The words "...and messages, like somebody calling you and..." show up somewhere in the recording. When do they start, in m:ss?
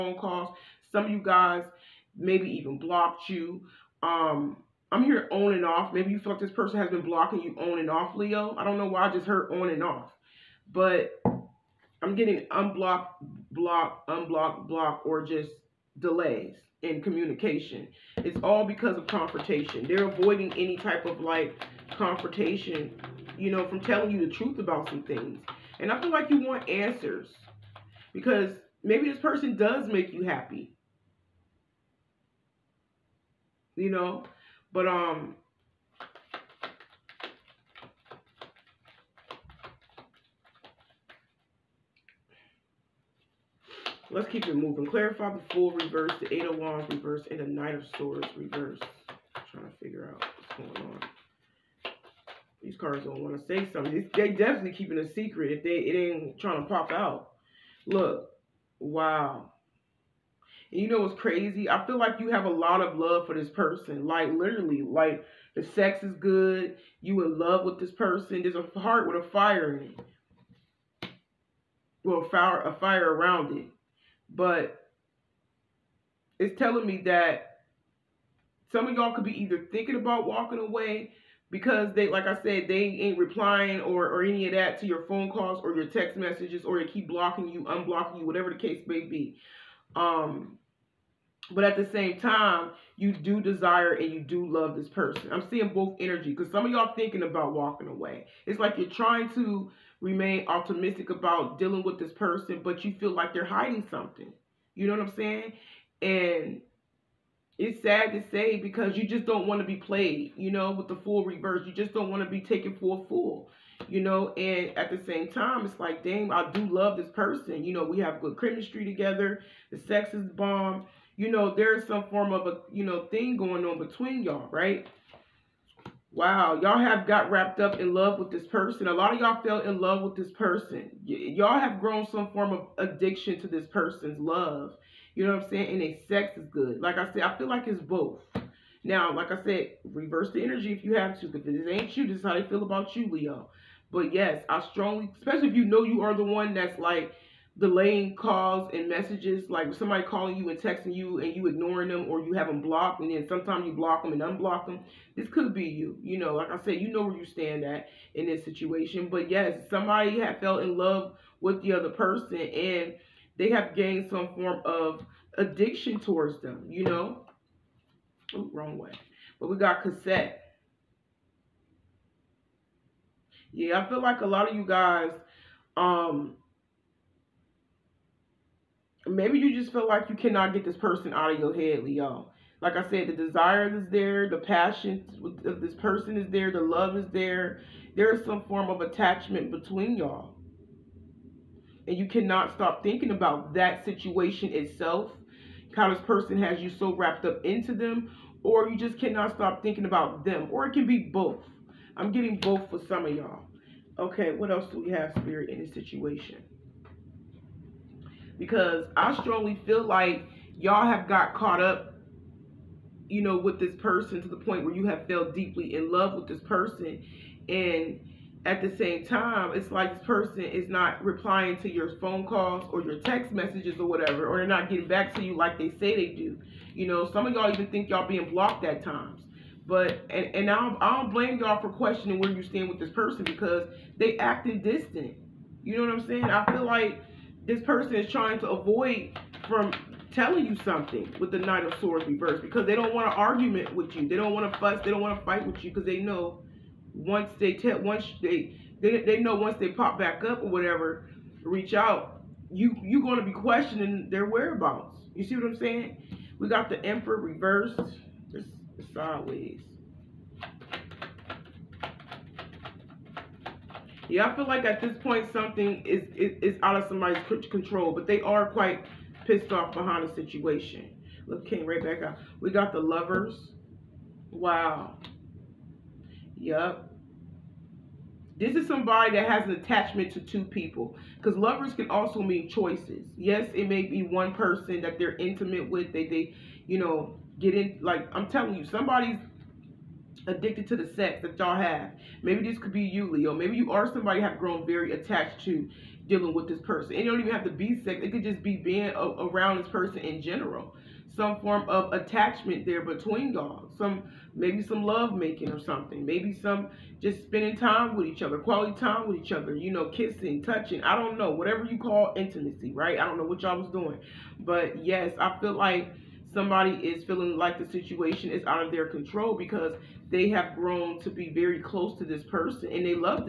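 2:28.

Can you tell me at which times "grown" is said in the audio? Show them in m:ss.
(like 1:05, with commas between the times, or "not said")
2:11, 4:54, 5:20.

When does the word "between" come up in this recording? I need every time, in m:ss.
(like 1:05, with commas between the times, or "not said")
2:03, 3:09, 5:02.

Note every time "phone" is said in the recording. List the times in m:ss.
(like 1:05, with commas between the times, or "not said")
1:25, 3:41.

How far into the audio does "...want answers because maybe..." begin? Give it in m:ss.
0:26.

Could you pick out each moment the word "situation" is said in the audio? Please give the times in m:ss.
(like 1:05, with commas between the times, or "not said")
2:38, 3:13, 3:25, 4:30, 5:17.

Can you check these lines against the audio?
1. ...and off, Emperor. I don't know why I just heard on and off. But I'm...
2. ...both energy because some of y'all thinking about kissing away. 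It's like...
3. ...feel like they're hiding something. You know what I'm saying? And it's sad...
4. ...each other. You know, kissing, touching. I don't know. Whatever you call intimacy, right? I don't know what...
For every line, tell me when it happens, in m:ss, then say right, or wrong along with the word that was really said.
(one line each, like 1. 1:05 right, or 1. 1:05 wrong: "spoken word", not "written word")
1. 0:07 wrong: "Leo", not "Emperor"
2. 1:35 wrong: "walking", not "kissing"
3. 1:42 right
4. 5:09 right.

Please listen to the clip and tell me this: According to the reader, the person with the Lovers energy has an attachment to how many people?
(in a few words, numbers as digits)
2.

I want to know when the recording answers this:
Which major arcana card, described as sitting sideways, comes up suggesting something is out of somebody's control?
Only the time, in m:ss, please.
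4:16.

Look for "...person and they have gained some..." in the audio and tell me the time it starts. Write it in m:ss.
2:41.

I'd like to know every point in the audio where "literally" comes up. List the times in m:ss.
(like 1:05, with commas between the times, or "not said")
1:04.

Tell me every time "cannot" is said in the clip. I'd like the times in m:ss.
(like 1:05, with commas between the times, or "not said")
3:00, 3:12, 3:18.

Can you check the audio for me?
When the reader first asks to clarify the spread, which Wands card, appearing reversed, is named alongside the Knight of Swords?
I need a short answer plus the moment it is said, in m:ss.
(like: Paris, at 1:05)
Eight of Wands, at 0:46.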